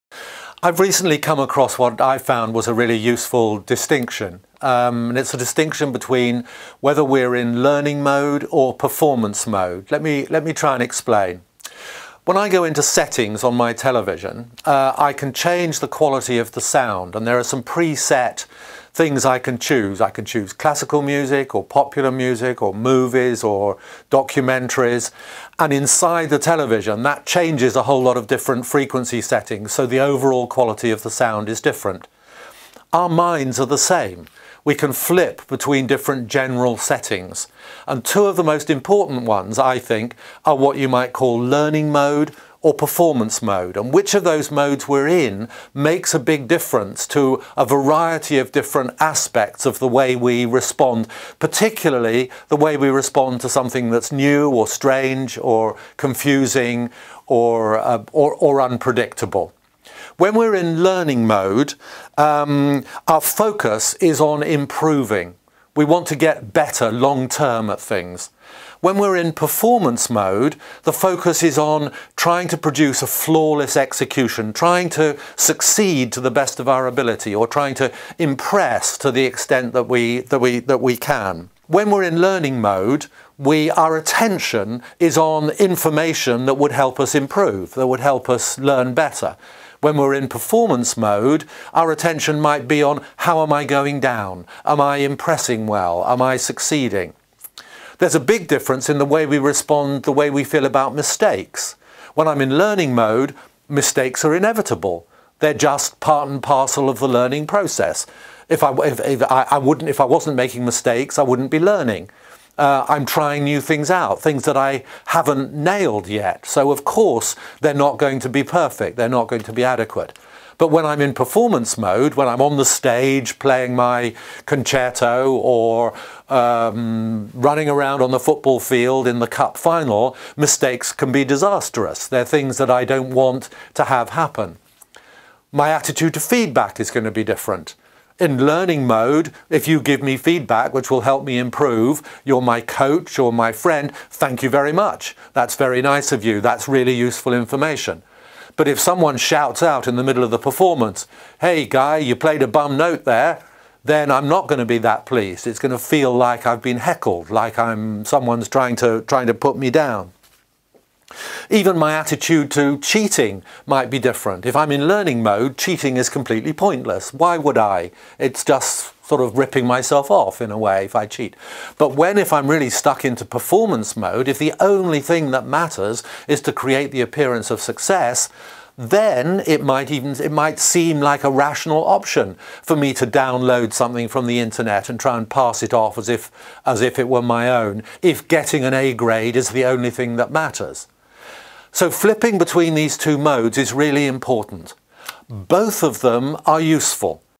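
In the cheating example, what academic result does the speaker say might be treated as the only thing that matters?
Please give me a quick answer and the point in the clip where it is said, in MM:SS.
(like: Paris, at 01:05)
A grade, at 03:08.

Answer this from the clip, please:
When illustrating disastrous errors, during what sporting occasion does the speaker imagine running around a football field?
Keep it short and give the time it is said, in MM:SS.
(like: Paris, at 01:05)
cup final, at 02:09.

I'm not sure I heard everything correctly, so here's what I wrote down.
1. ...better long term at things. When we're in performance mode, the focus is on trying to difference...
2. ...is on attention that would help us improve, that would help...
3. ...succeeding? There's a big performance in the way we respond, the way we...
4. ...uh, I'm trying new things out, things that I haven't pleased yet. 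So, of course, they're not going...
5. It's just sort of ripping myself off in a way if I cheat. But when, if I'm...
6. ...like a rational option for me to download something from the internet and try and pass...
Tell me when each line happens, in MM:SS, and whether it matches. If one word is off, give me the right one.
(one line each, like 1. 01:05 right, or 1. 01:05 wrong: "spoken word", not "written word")
1. 01:06 wrong: "produce", not "difference"
2. 01:24 wrong: "information", not "attention"
3. 01:36 wrong: "difference", not "performance"
4. 01:52 wrong: "nailed", not "pleased"
5. 02:48 right
6. 03:01 right.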